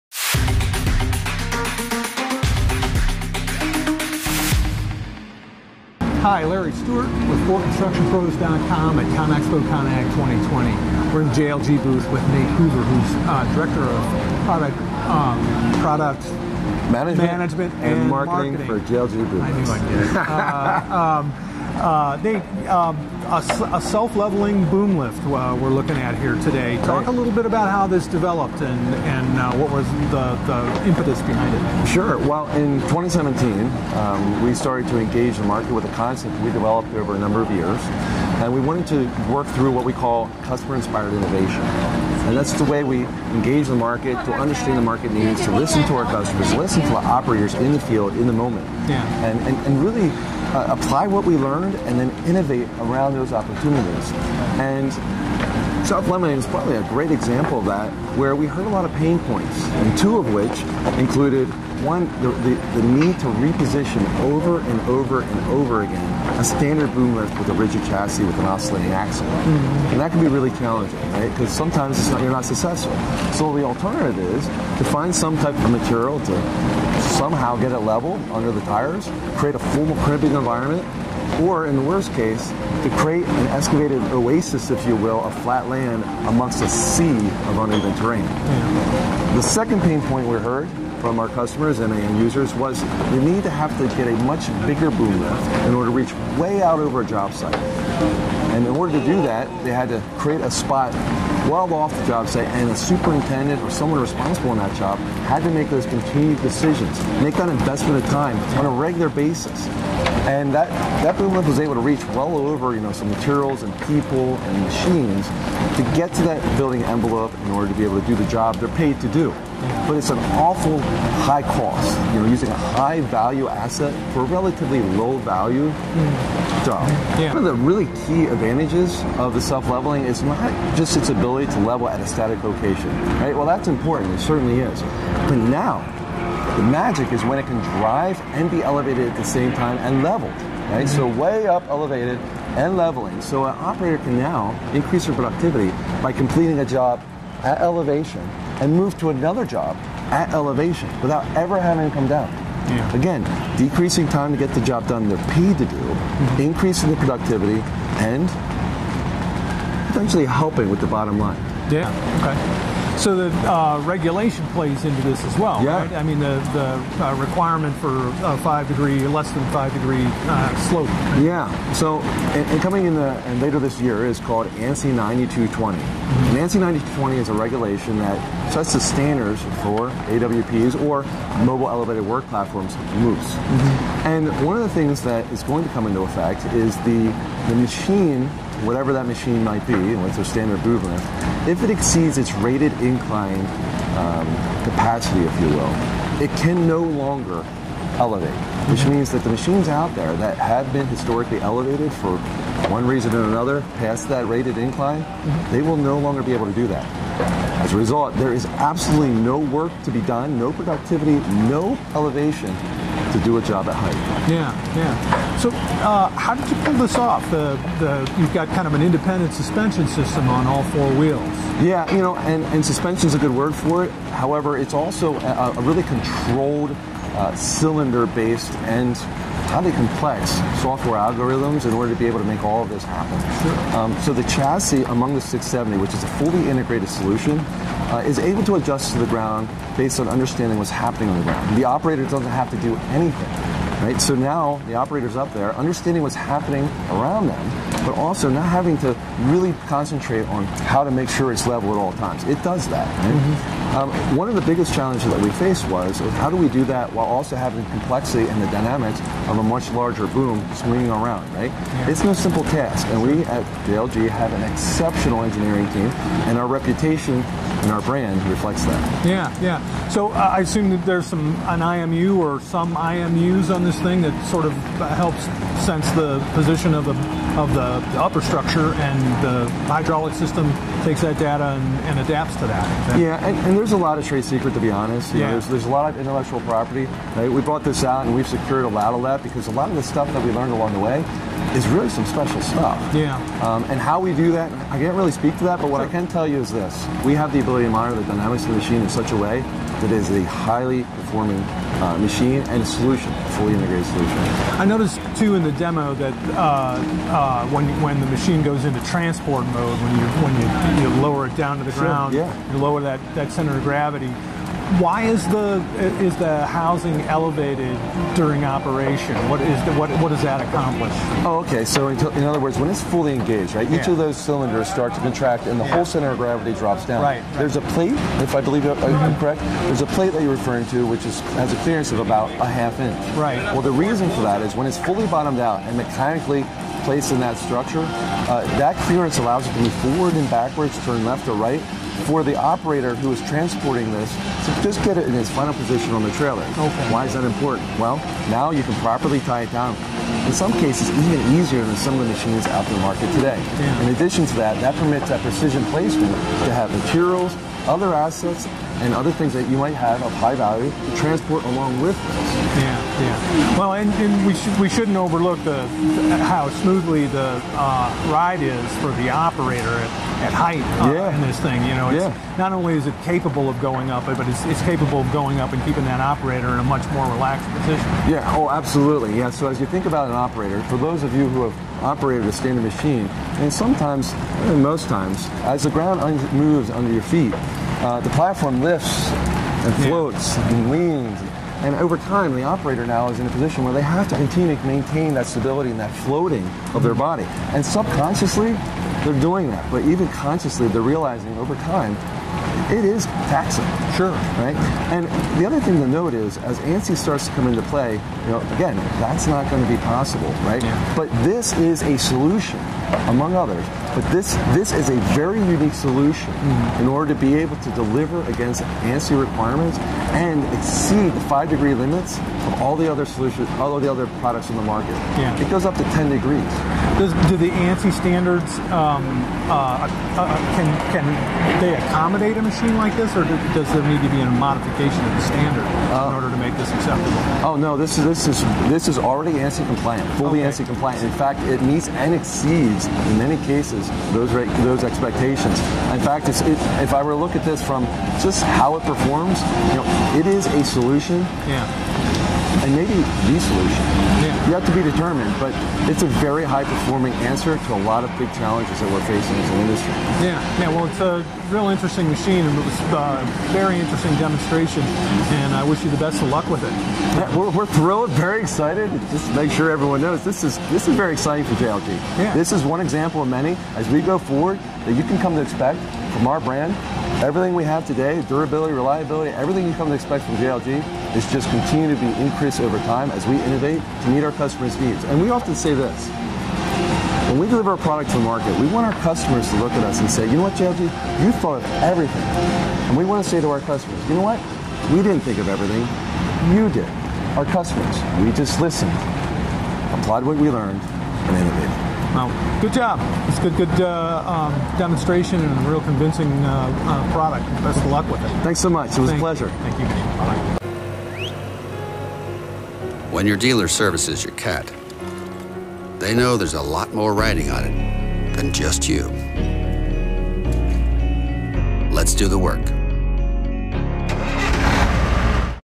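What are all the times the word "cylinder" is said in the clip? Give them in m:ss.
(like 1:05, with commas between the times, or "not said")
3:47, 5:24.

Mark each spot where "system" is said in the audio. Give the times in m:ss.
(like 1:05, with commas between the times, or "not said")
3:39, 4:40.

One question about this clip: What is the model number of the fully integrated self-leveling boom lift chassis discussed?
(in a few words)
670.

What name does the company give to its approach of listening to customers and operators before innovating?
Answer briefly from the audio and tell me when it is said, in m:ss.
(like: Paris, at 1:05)
customer-inspired innovation, at 0:40.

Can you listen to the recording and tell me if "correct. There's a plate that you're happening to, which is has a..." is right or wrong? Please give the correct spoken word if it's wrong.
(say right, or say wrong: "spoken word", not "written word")
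wrong: "referring", not "happening".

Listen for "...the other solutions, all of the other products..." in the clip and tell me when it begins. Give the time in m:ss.
7:02.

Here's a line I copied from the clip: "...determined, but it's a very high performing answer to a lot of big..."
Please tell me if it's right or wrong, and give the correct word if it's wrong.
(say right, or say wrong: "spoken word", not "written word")
right.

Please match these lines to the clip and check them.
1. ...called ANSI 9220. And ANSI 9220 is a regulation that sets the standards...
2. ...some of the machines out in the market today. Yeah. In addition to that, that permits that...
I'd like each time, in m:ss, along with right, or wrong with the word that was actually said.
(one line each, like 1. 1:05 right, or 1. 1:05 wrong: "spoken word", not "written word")
1. 2:54 right
2. 5:51 right.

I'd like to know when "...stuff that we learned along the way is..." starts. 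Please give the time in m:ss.
4:49.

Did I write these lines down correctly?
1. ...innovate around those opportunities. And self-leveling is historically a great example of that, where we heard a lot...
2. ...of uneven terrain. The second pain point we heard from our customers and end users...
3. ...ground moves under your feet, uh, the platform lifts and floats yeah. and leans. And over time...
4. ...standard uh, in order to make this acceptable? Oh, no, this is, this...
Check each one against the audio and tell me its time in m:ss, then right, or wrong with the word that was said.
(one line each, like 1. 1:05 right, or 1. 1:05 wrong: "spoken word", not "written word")
1. 0:52 wrong: "probably", not "historically"
2. 1:27 right
3. 6:25 right
4. 7:15 right.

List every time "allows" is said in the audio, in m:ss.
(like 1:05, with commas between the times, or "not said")
5:39.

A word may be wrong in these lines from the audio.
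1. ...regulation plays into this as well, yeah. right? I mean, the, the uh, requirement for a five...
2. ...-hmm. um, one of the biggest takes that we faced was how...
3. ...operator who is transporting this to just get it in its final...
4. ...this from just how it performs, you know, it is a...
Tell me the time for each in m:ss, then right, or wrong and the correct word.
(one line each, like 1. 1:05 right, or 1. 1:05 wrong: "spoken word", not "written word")
1. 2:43 right
2. 4:13 wrong: "challenges", not "takes"
3. 5:42 right
4. 7:27 right.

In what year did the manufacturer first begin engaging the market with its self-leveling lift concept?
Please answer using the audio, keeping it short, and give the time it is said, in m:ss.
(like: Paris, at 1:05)
2017, at 0:32.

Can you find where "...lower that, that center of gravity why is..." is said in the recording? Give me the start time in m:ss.
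5:12.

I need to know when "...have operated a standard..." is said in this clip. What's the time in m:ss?
6:21.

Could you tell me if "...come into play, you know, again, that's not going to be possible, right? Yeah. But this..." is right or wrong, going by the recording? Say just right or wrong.
right.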